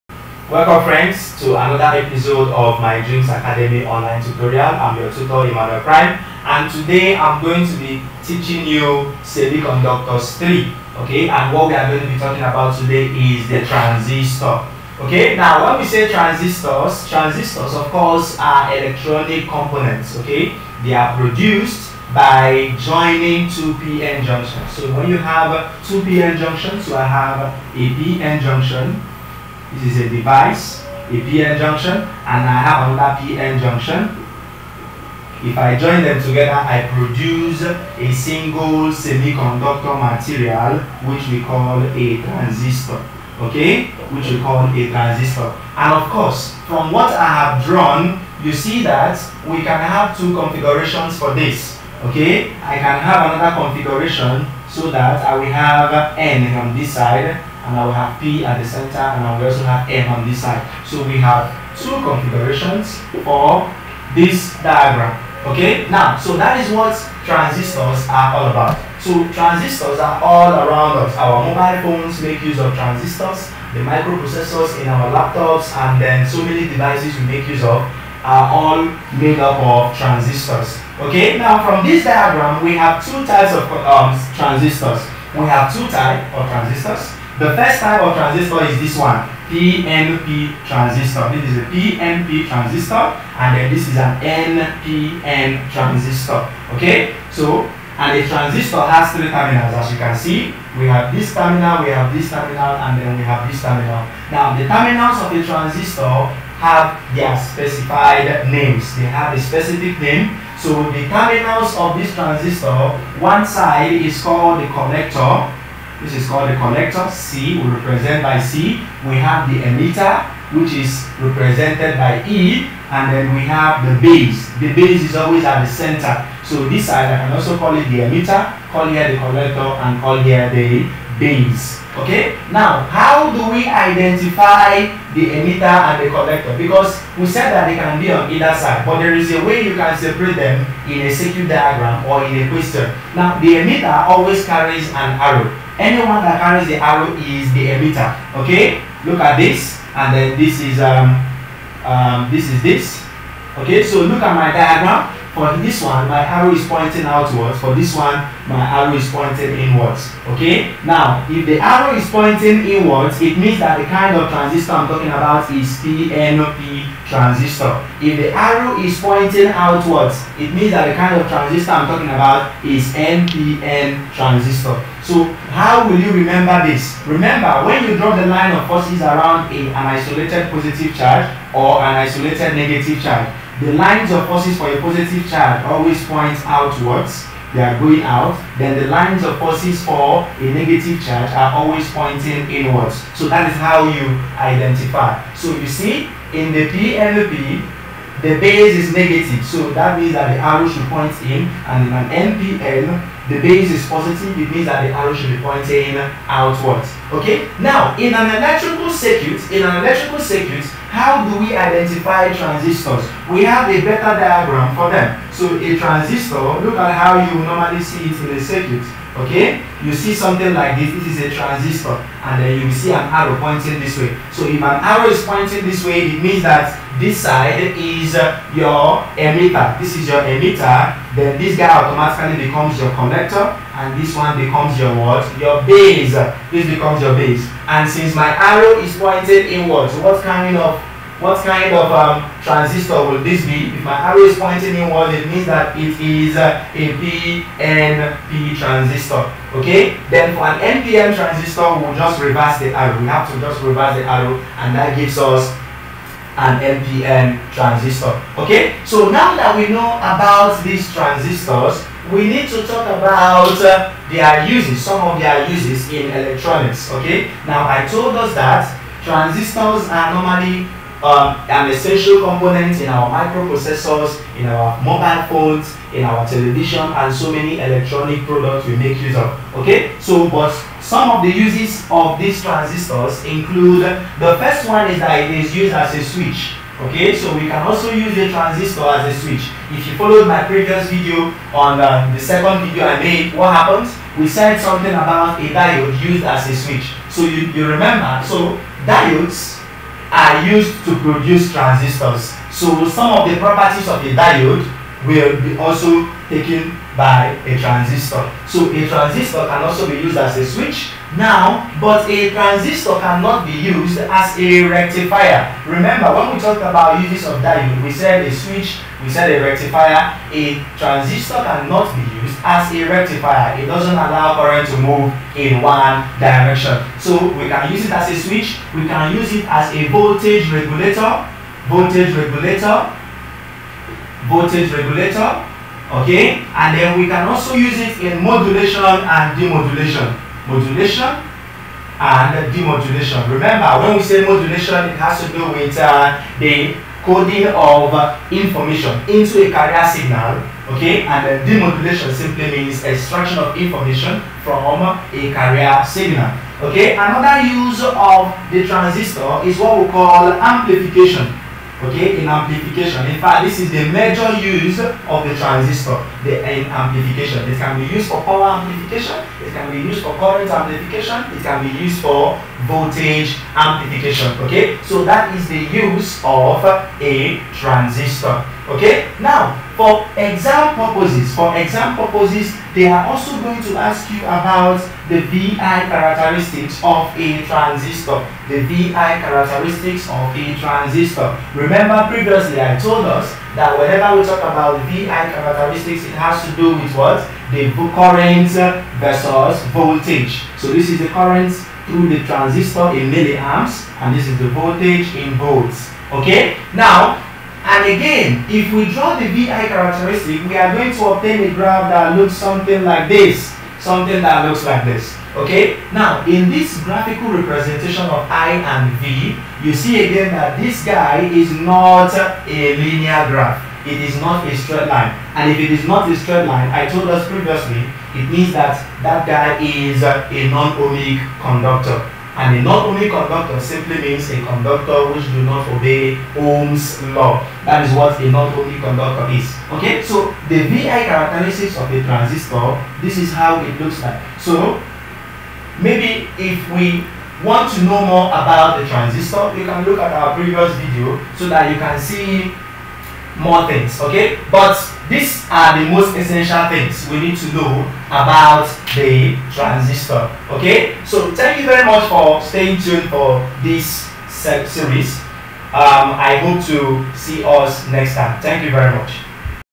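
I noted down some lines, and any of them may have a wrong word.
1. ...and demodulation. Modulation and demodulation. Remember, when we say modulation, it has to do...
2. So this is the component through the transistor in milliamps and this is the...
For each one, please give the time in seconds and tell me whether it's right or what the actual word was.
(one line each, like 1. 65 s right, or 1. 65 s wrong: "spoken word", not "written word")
1. 338 s right
2. 400 s wrong: "current", not "component".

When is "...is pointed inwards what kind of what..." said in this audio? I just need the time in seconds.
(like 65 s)
238 s.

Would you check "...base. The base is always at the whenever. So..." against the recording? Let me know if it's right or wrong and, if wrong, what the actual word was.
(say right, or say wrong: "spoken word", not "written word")
wrong: "center", not "whenever".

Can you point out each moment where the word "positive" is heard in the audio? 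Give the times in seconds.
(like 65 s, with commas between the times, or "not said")
180 s, 184 s, 203 s.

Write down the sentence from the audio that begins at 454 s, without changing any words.
But these are the most essential things we need to know about the transistor.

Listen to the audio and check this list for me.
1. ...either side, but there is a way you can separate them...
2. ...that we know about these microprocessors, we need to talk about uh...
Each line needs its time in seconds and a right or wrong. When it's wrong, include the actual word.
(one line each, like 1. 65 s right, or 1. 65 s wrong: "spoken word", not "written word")
1. 138 s right
2. 259 s wrong: "transistors", not "microprocessors".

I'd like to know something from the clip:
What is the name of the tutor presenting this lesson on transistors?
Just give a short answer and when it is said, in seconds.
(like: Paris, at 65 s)
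Emmanuel Prime, at 5 s.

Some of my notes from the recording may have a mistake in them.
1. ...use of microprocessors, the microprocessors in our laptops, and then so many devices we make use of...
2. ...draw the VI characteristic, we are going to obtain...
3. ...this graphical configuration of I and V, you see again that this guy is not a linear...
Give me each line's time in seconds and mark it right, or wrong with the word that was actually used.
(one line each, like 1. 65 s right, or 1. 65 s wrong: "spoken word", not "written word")
1. 72 s wrong: "transistors", not "microprocessors"
2. 408 s right
3. 416 s wrong: "representation", not "configuration".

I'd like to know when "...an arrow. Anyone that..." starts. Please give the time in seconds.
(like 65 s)
144 s.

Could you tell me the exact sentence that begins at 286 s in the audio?
Okay, so we can also use the transistor as a switch.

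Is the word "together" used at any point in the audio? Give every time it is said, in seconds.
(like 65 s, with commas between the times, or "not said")
36 s.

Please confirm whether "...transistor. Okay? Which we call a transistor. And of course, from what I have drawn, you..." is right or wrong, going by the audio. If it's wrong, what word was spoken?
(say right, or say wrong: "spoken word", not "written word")
right.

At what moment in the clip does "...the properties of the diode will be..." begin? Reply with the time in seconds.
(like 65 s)
303 s.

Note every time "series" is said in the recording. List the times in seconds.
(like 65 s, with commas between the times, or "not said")
464 s.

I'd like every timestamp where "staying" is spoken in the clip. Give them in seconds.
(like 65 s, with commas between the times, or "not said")
462 s.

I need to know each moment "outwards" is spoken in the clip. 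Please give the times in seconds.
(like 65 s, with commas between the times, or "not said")
157 s, 169 s, 186 s, 206 s.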